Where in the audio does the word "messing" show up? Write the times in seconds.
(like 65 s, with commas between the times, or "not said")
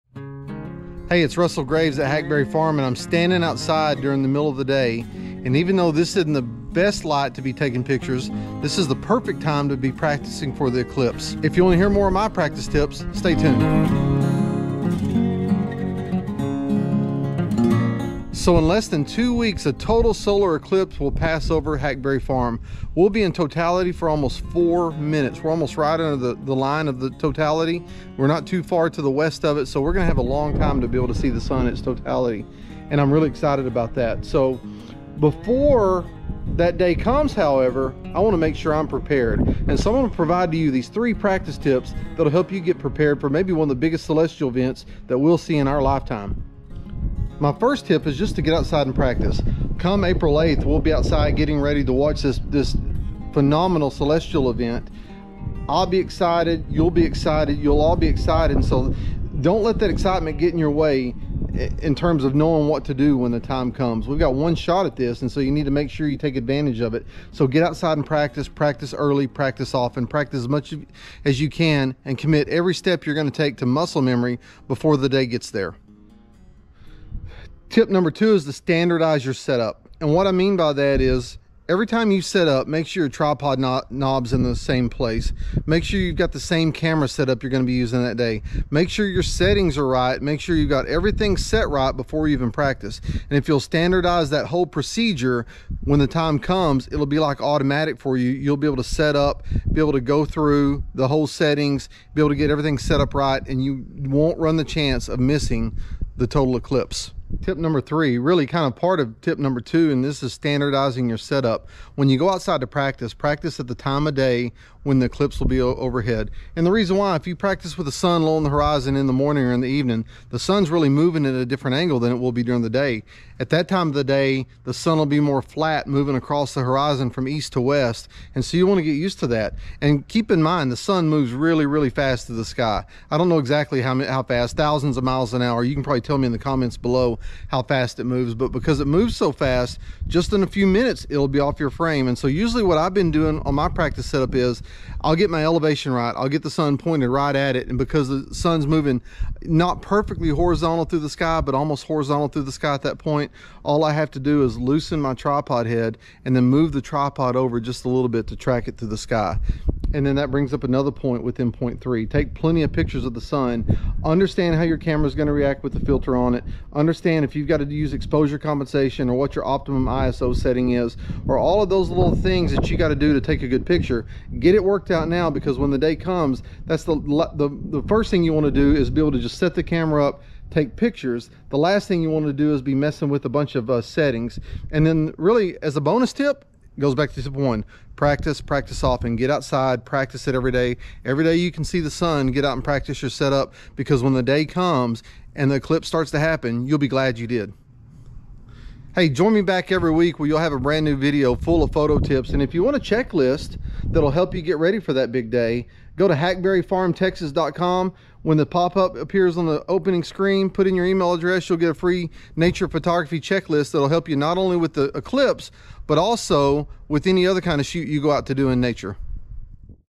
182 s.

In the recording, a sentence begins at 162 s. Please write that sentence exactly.
Take plenty of pictures of the sun.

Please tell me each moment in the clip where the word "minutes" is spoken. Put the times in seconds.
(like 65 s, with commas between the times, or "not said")
24 s, 140 s.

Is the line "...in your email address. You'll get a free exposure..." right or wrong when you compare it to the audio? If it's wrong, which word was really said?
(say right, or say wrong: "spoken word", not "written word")
wrong: "nature", not "exposure".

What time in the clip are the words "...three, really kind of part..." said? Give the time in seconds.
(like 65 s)
107 s.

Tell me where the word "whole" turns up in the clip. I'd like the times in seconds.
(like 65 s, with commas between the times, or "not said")
94 s, 101 s.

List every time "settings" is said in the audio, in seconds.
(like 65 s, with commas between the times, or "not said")
89 s, 101 s, 170 s, 183 s.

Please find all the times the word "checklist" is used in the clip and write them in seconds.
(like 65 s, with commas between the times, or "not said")
202 s, 213 s.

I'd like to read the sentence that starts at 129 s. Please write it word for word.
And keep in mind, the sun moves really, really fast to the sky.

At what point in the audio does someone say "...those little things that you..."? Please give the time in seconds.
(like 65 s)
171 s.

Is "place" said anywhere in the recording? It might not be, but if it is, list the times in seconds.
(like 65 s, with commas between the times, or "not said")
84 s.